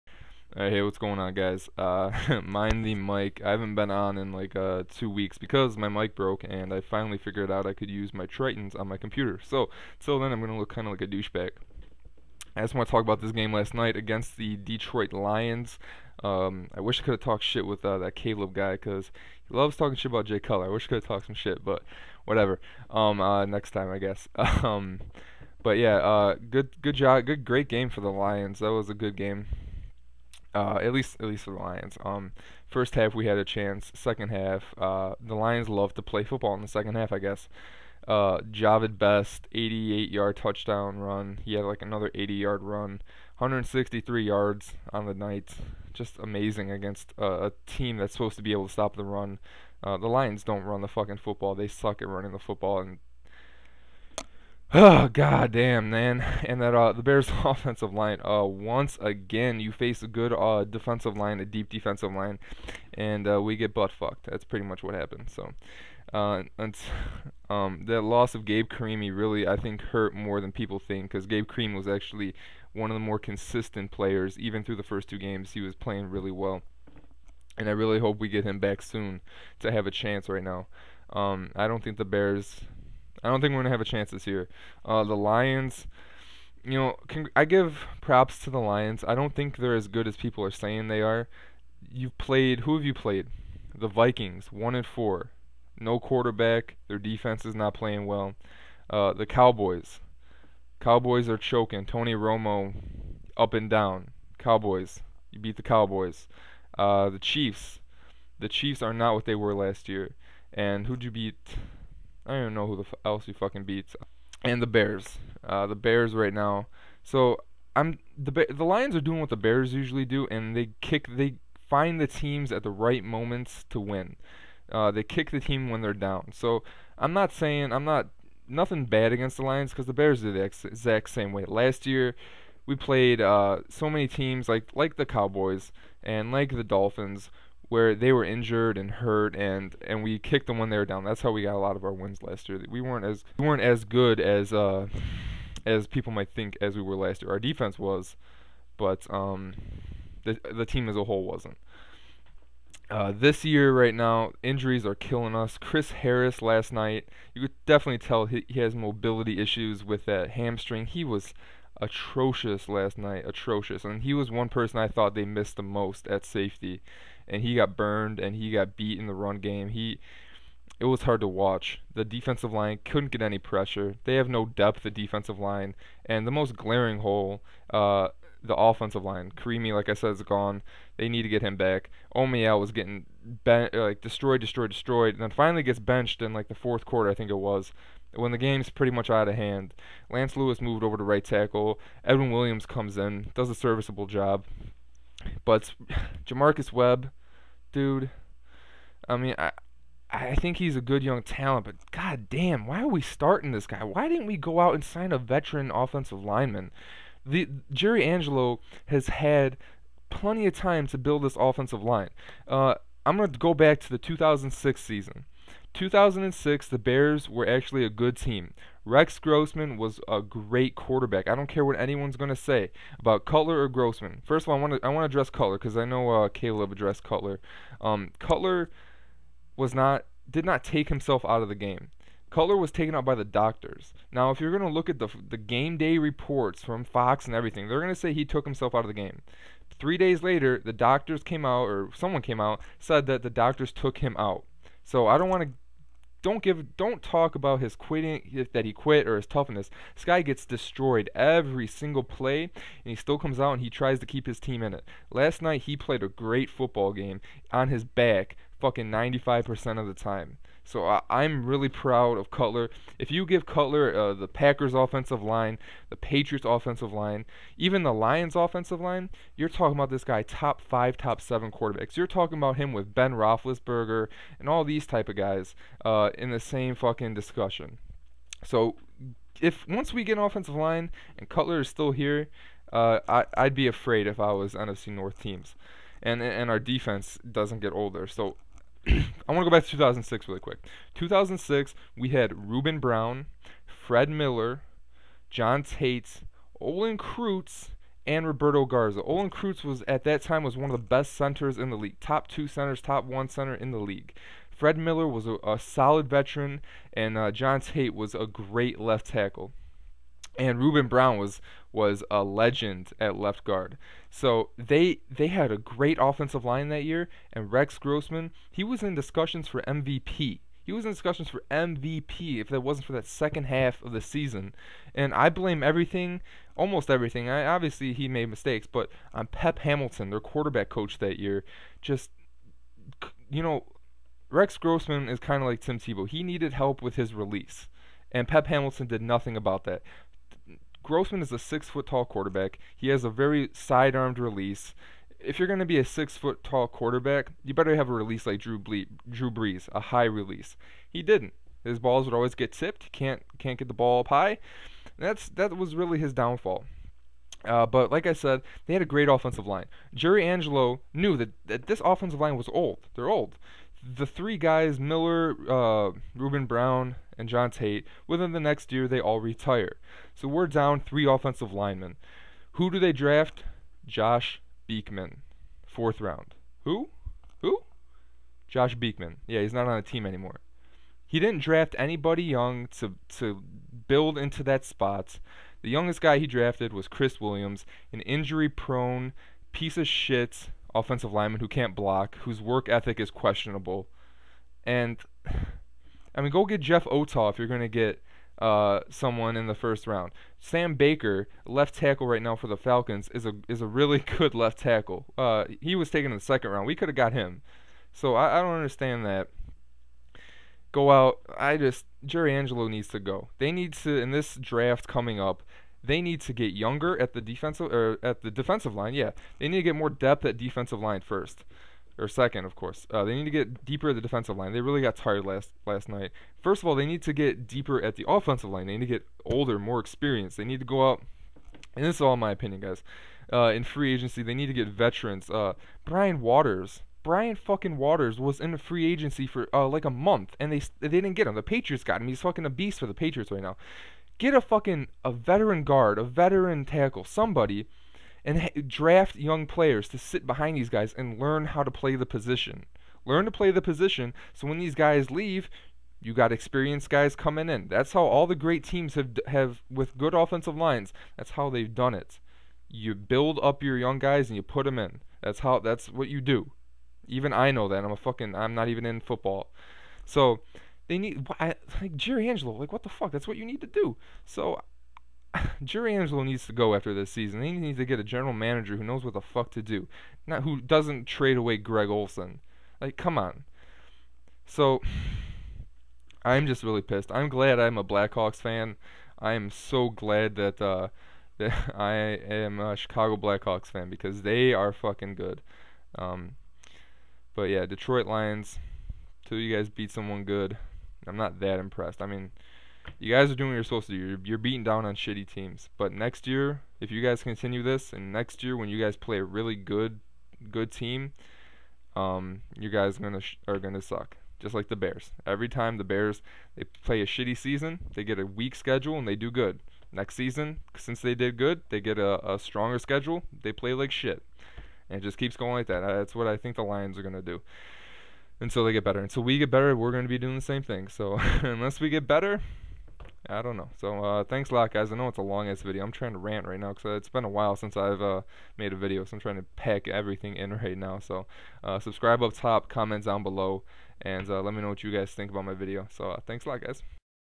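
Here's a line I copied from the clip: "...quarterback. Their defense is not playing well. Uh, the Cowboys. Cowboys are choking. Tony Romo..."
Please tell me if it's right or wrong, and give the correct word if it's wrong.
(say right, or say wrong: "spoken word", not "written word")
right.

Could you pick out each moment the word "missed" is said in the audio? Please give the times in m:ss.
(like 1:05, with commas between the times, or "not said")
2:45.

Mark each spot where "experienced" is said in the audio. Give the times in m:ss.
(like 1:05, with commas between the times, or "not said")
7:09, 7:36.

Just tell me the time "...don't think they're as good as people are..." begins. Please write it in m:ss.
1:29.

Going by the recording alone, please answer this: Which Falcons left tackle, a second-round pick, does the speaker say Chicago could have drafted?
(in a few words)
Sam Baker.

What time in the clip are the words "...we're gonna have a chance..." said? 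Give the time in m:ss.
1:23.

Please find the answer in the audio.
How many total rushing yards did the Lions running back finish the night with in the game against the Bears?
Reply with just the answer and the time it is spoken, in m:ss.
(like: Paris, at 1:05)
163, at 0:43.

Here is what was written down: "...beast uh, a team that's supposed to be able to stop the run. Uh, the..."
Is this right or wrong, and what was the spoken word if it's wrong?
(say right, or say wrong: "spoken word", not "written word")
wrong: "against", not "beast".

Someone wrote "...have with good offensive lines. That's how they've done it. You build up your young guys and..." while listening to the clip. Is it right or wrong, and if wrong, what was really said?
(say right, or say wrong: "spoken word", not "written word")
right.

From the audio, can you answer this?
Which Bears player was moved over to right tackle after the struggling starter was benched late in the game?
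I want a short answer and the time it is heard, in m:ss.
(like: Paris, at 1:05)
Lance Louis, at 3:10.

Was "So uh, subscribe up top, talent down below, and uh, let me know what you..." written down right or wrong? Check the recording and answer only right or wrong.
wrong.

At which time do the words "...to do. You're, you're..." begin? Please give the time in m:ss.
8:23.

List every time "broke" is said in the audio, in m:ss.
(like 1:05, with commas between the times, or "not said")
0:06.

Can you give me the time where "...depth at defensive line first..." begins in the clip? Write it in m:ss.
6:59.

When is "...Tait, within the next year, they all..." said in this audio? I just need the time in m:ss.
6:07.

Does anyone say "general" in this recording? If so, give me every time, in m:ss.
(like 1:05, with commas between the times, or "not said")
7:58.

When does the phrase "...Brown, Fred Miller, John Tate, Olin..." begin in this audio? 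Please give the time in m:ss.
4:52.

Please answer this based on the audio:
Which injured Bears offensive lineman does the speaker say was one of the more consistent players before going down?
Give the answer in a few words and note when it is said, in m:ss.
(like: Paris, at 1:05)
Gabe Carimi, at 1:08.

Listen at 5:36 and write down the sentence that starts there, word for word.
He needed help with his release and Pep Hamilton did nothing about that.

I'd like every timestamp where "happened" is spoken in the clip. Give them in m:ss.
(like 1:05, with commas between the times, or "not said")
1:04.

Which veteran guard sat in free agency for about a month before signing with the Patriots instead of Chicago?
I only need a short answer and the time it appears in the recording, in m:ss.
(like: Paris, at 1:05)
Brian Waters, at 7:15.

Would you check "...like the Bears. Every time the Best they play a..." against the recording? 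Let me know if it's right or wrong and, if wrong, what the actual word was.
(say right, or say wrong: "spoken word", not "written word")
wrong: "Bears", not "Best".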